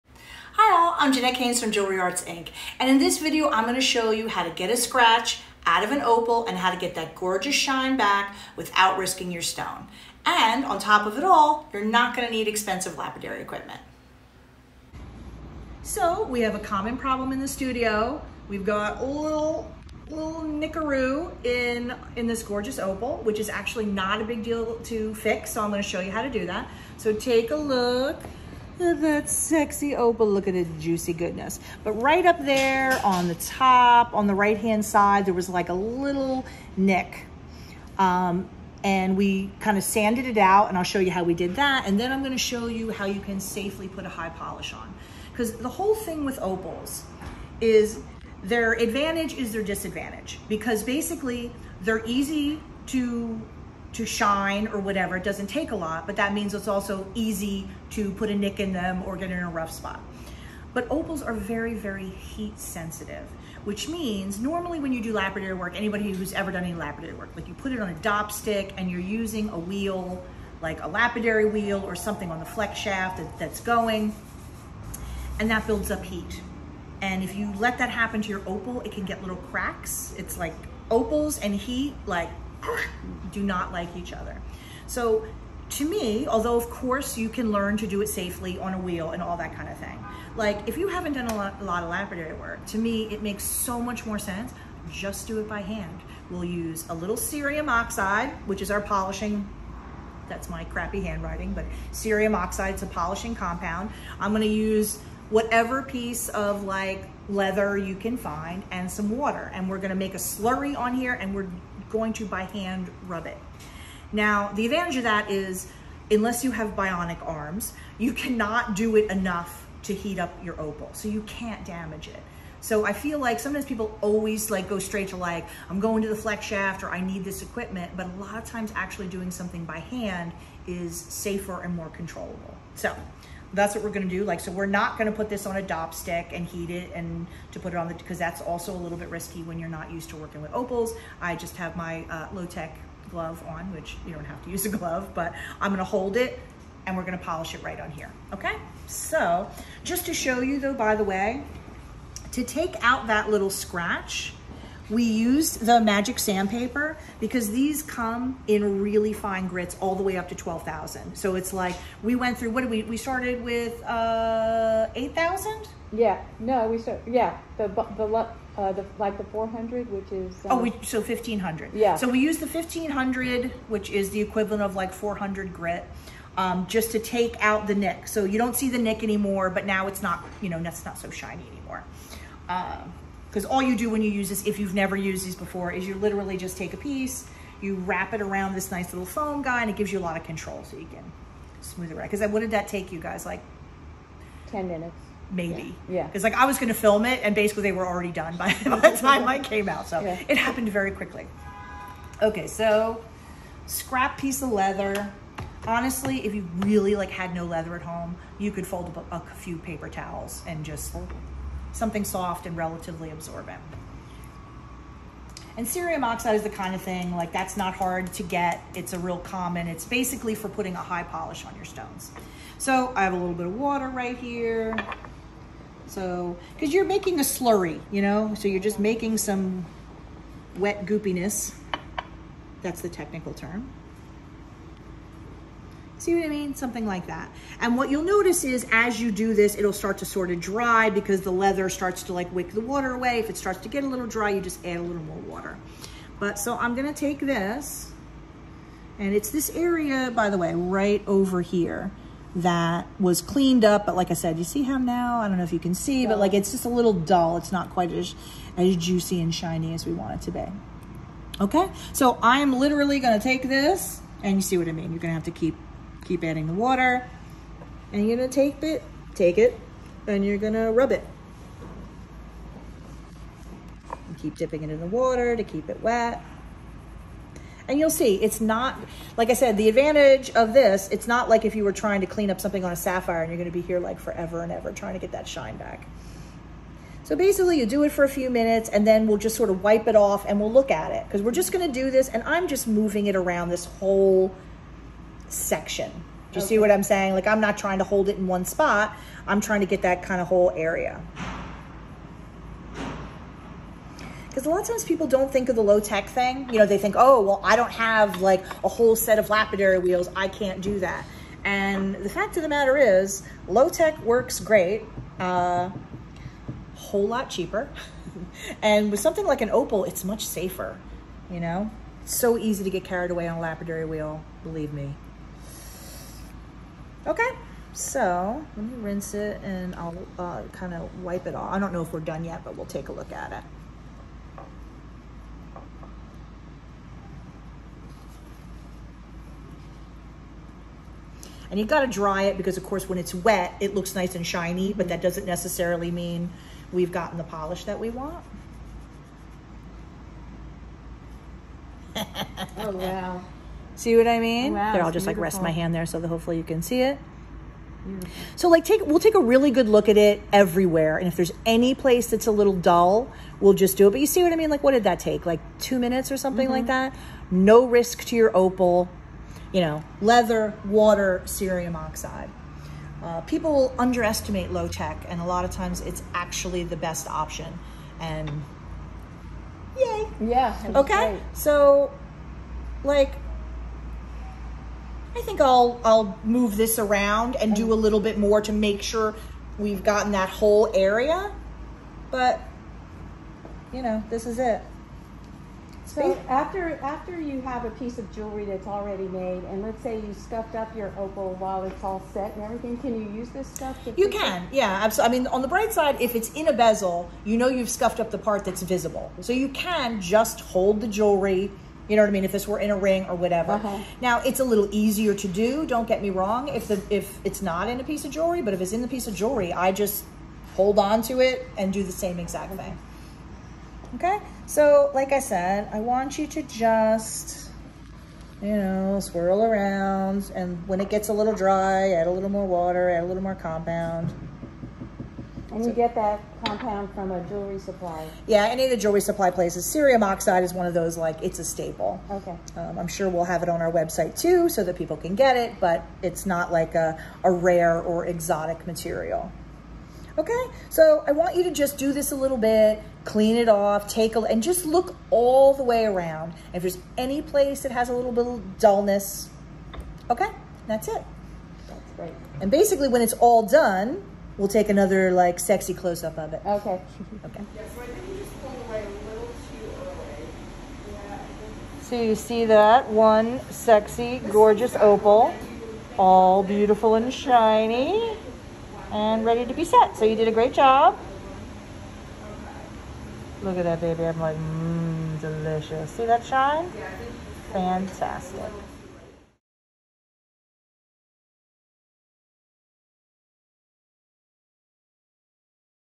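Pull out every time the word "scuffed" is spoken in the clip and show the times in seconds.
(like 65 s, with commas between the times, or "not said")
400 s, 407 s.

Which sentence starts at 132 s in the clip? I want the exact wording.
So that's what we're gonna do.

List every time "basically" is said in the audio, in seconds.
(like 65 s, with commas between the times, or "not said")
50 s, 197 s, 219 s, 287 s, 462 s.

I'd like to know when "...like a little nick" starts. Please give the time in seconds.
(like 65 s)
35 s.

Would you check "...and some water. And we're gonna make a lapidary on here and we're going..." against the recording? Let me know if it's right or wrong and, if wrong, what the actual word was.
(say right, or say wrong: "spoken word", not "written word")
wrong: "slurry", not "lapidary".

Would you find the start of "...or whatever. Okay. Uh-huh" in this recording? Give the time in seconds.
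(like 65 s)
413 s.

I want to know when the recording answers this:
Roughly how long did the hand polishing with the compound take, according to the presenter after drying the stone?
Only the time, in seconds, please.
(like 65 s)
365 s.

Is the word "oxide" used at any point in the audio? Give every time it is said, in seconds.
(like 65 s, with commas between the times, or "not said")
97 s, 102 s, 216 s, 371 s, 440 s.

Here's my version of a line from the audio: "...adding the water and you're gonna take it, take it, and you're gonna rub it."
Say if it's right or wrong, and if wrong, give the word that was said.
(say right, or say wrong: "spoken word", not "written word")
right.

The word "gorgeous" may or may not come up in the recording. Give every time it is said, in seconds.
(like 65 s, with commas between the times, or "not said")
7 s, 22 s, 474 s.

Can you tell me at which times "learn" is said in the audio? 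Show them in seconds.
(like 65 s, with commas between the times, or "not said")
87 s.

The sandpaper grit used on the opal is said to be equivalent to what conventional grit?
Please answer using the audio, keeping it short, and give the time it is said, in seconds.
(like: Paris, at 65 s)
400, at 174 s.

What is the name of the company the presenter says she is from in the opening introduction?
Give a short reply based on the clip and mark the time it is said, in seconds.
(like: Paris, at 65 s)
Jewelry Arts Inc., at 1 s.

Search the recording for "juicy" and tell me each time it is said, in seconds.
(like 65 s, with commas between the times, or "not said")
30 s, 258 s.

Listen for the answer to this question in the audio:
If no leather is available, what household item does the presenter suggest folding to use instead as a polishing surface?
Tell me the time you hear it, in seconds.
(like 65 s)
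209 s.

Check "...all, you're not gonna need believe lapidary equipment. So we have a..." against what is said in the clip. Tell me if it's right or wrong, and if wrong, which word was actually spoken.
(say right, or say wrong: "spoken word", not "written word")
wrong: "expensive", not "believe".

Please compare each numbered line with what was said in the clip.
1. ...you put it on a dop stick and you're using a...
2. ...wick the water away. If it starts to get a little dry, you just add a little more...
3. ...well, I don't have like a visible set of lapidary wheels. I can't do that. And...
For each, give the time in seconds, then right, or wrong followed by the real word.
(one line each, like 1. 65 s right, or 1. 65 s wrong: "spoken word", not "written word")
1. 67 s right
2. 242 s right
3. 307 s wrong: "whole", not "visible".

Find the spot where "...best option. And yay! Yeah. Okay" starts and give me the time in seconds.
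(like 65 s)
376 s.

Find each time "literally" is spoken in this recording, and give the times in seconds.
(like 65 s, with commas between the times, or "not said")
185 s, 262 s.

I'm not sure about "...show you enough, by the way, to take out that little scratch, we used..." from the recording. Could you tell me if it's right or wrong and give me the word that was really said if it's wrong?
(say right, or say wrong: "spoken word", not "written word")
wrong: "though", not "enough".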